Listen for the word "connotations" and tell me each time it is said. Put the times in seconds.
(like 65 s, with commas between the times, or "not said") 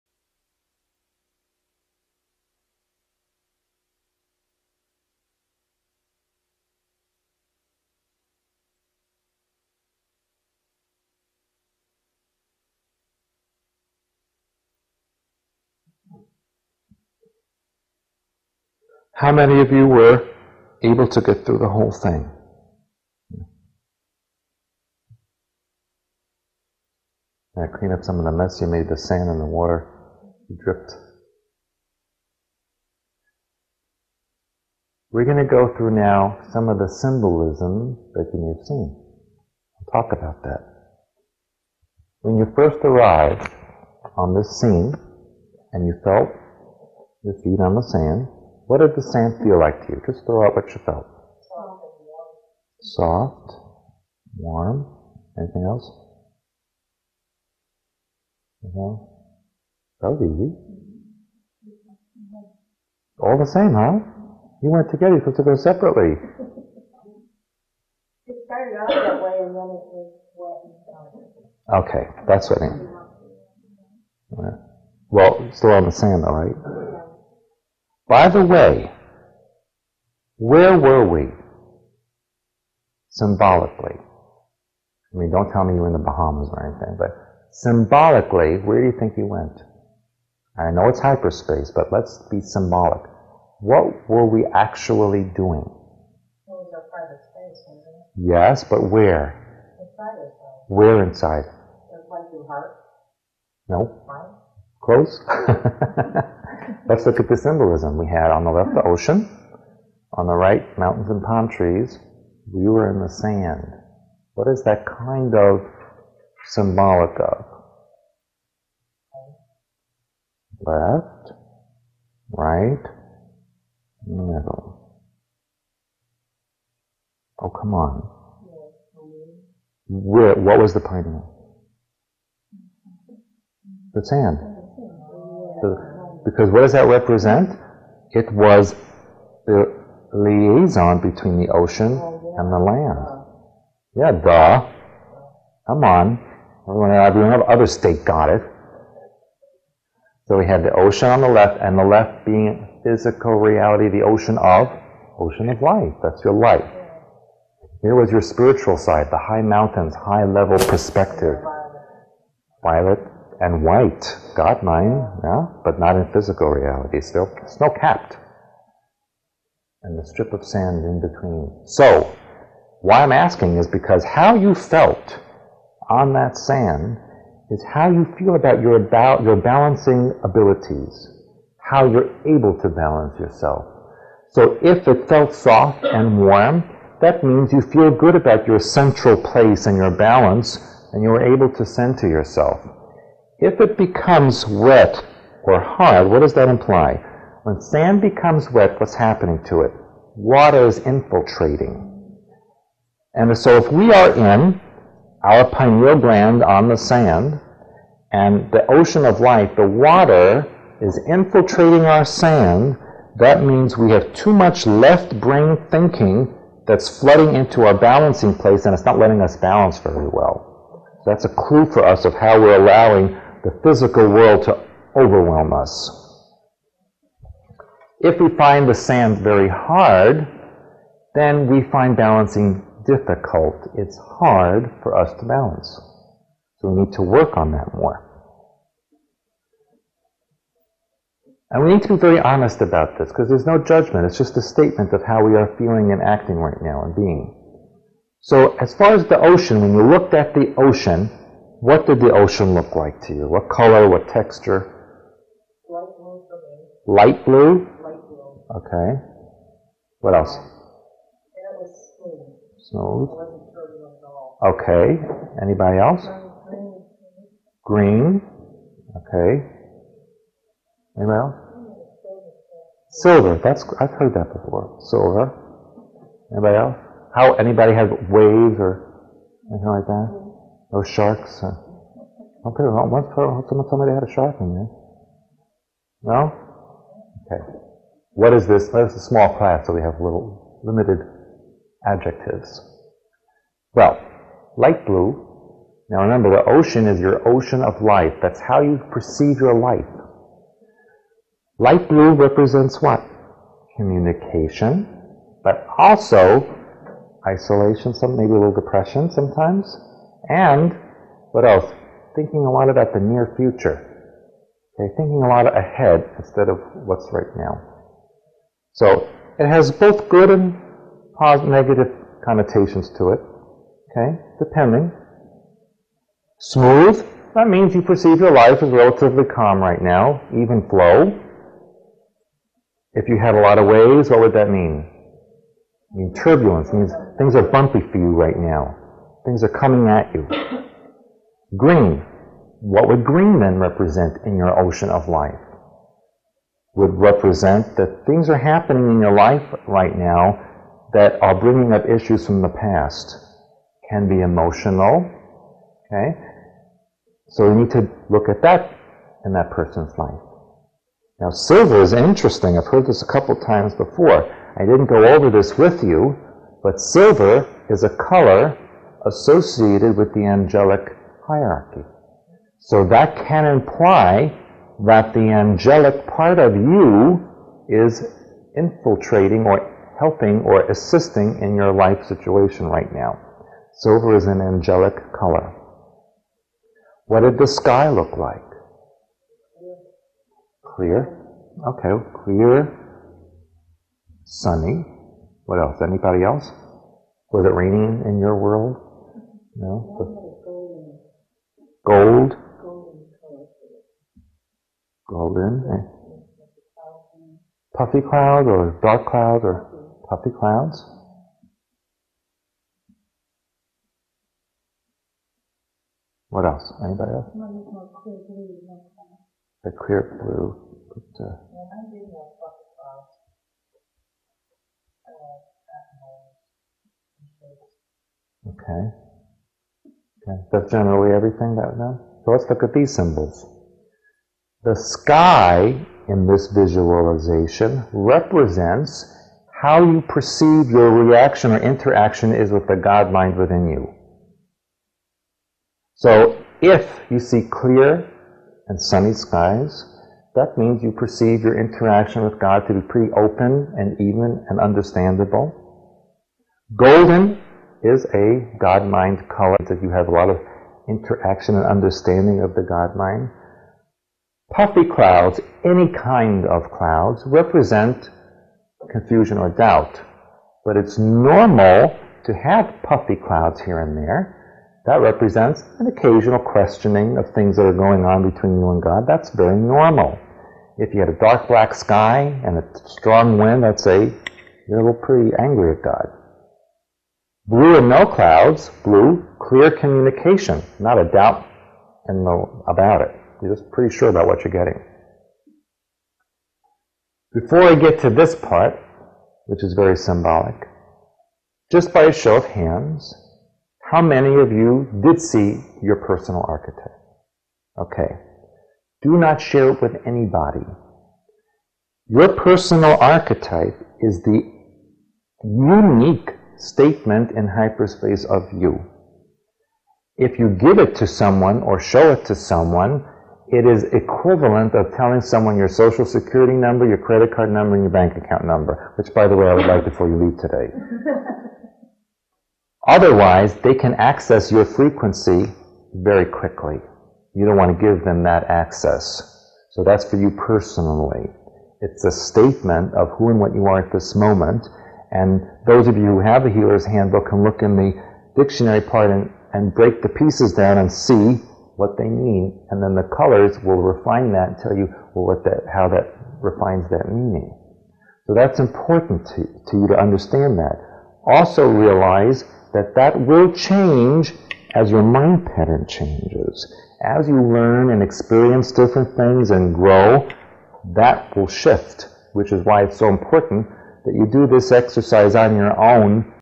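322 s.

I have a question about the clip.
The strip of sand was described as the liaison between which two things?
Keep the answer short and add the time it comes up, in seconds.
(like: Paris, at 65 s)
The ocean and the land, at 141 s.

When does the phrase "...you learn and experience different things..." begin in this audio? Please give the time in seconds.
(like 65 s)
567 s.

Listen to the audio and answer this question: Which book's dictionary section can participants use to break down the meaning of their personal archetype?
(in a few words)
The Healer's Handbook.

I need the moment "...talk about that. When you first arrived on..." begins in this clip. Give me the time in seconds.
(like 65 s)
40 s.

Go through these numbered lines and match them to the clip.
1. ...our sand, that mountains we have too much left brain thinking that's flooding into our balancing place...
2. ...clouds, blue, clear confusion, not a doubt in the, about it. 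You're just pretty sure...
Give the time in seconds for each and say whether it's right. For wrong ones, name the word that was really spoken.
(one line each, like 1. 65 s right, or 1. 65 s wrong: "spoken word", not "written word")
1. 211 s wrong: "means", not "mountains"
2. 488 s wrong: "communication", not "confusion".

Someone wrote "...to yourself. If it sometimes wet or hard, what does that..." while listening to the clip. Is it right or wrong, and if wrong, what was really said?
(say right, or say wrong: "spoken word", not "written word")
wrong: "becomes", not "sometimes".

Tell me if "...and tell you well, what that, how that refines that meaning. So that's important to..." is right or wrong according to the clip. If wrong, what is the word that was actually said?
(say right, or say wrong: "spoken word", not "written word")
right.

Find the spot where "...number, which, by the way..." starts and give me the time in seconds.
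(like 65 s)
528 s.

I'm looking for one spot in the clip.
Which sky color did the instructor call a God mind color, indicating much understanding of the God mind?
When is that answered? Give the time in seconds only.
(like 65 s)
456 s.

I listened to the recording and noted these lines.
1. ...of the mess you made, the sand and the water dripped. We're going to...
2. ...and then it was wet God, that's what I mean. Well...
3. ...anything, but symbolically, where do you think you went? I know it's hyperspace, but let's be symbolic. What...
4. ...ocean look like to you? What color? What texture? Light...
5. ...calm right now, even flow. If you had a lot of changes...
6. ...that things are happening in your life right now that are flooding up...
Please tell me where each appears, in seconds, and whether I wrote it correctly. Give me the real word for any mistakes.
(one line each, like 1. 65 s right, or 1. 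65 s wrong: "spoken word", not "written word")
1. 28 s right
2. 69 s wrong: "Okay", not "God"
3. 86 s right
4. 252 s right
5. 329 s wrong: "waves", not "changes"
6. 347 s wrong: "bringing", not "flooding".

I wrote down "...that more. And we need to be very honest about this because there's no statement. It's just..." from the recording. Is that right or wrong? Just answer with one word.
wrong.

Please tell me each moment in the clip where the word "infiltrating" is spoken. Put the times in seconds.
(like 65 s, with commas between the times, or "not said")
200 s, 211 s, 378 s.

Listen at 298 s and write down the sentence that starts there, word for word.
That's how you perceive your life.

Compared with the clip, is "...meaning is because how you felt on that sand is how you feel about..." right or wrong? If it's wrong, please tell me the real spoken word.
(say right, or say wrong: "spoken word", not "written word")
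wrong: "asking", not "meaning".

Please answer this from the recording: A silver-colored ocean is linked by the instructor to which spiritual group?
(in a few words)
The angelic hierarchy.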